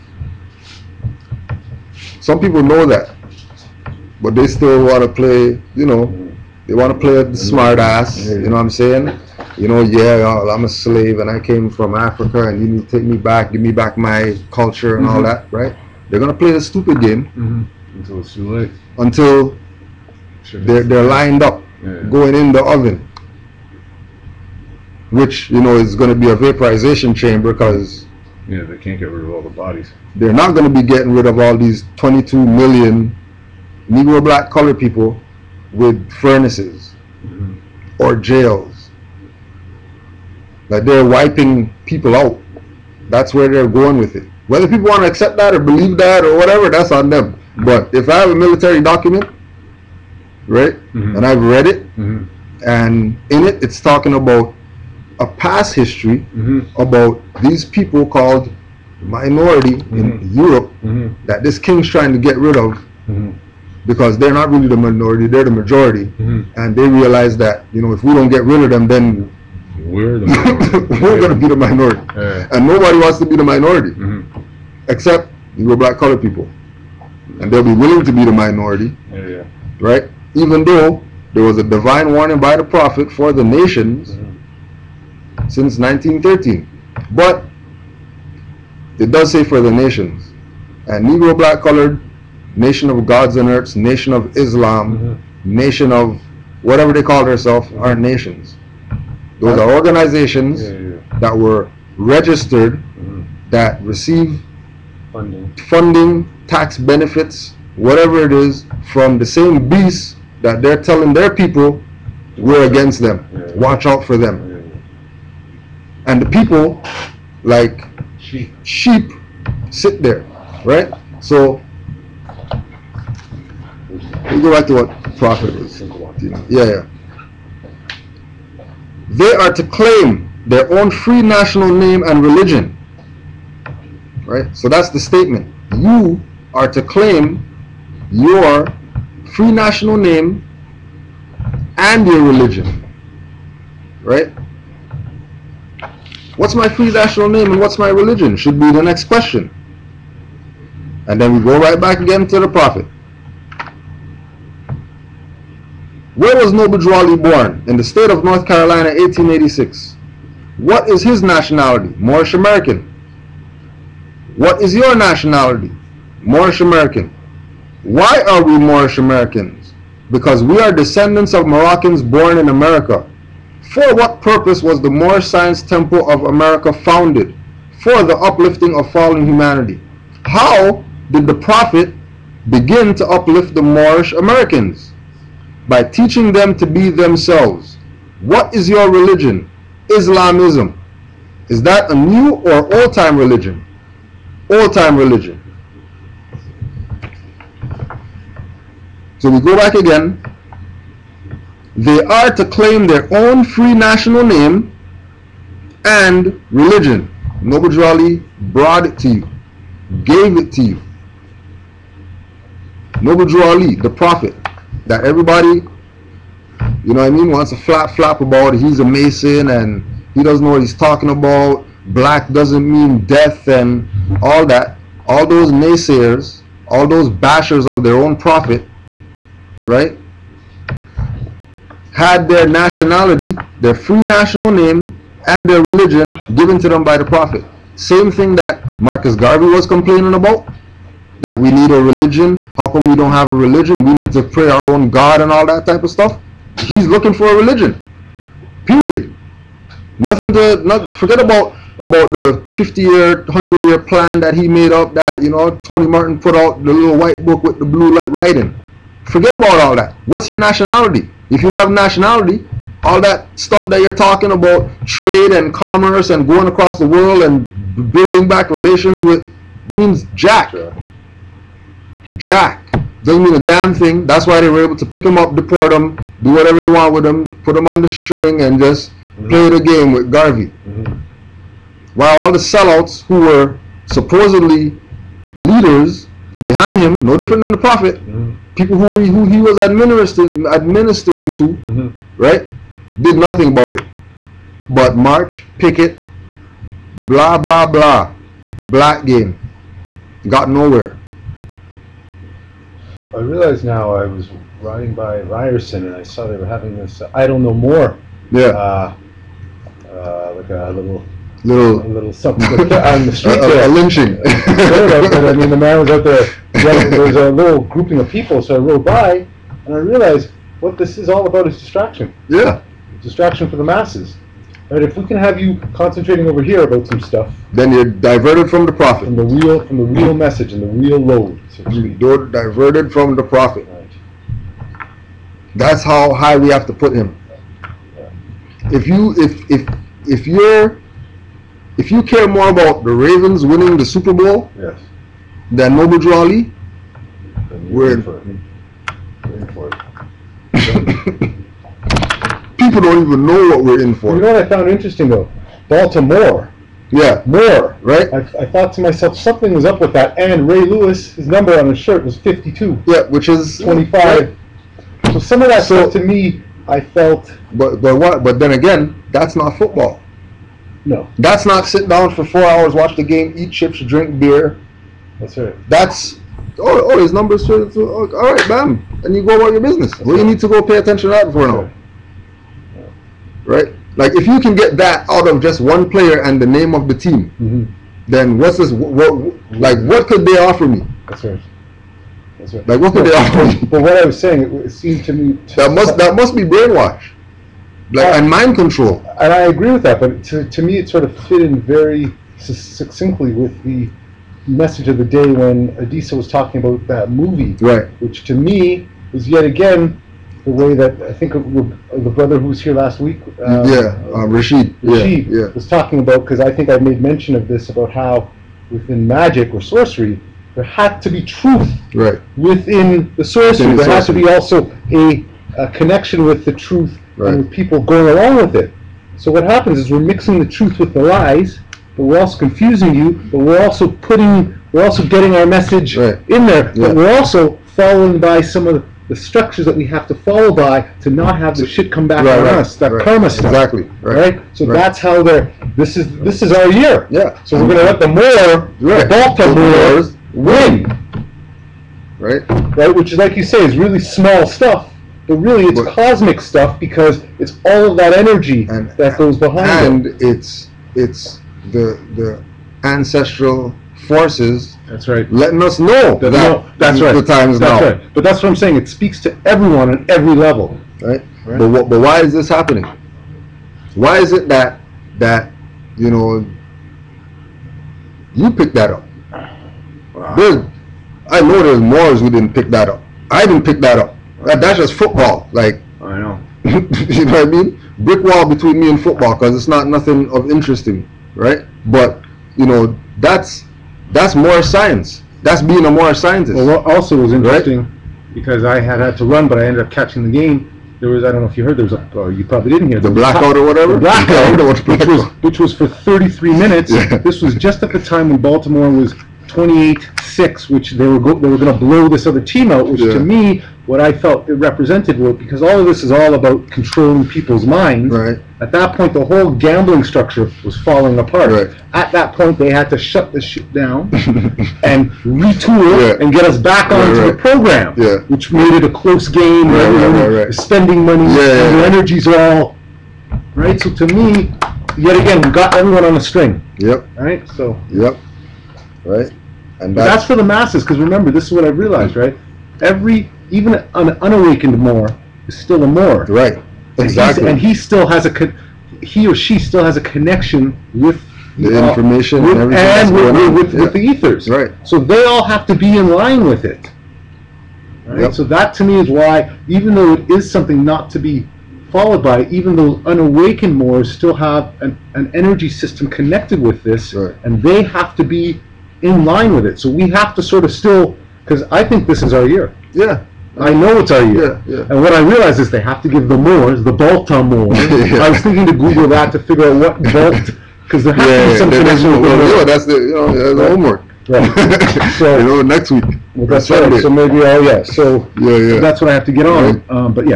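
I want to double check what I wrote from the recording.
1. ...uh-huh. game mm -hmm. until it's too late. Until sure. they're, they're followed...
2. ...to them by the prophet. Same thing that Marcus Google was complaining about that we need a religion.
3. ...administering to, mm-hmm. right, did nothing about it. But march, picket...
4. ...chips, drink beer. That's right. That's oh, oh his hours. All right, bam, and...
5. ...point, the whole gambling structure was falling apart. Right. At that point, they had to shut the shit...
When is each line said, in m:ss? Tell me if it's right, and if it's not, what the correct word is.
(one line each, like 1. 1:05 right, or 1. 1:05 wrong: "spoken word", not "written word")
1. 0:16 wrong: "lined", not "followed"
2. 3:56 wrong: "Garvey", not "Google"
3. 4:50 right
4. 6:13 wrong: "numbers", not "hours"
5. 8:38 right.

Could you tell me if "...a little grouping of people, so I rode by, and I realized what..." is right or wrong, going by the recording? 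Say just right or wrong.
right.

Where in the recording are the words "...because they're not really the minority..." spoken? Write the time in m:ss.
1:03.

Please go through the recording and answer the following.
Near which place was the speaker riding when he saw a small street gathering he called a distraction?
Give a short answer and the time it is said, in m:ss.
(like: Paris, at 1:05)
Ryerson, at 5:05.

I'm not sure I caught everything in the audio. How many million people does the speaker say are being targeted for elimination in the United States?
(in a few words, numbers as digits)
22 million.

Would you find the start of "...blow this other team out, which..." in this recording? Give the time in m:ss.
8:31.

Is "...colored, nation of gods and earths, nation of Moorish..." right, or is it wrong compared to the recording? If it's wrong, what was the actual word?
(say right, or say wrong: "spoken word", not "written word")
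wrong: "Islam", not "Moorish".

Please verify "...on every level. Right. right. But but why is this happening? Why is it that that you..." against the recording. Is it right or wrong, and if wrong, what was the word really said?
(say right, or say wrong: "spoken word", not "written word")
right.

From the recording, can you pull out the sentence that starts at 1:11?
We're going to be the minority.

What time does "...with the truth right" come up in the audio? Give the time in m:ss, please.
7:06.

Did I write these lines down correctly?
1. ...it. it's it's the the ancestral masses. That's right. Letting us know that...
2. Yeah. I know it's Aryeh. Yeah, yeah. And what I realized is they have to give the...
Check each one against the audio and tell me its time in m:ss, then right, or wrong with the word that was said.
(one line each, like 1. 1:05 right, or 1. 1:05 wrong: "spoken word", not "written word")
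1. 7:40 wrong: "forces", not "masses"
2. 9:32 right.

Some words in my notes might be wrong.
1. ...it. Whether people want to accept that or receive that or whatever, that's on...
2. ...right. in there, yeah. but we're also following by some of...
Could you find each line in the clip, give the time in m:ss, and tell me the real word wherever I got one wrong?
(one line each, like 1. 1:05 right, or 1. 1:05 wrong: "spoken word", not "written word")
1. 0:44 wrong: "believe", not "receive"
2. 7:15 right.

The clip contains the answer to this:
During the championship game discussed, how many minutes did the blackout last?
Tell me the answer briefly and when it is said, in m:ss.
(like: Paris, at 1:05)
33 minutes, at 8:25.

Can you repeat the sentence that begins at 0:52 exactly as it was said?
and in it it's talking about a past history mm -hmm.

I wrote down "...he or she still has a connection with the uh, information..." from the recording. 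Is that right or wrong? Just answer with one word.
right.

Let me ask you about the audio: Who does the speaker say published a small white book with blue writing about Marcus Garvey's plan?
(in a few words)
Tony Martin.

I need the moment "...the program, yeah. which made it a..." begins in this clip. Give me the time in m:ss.
8:47.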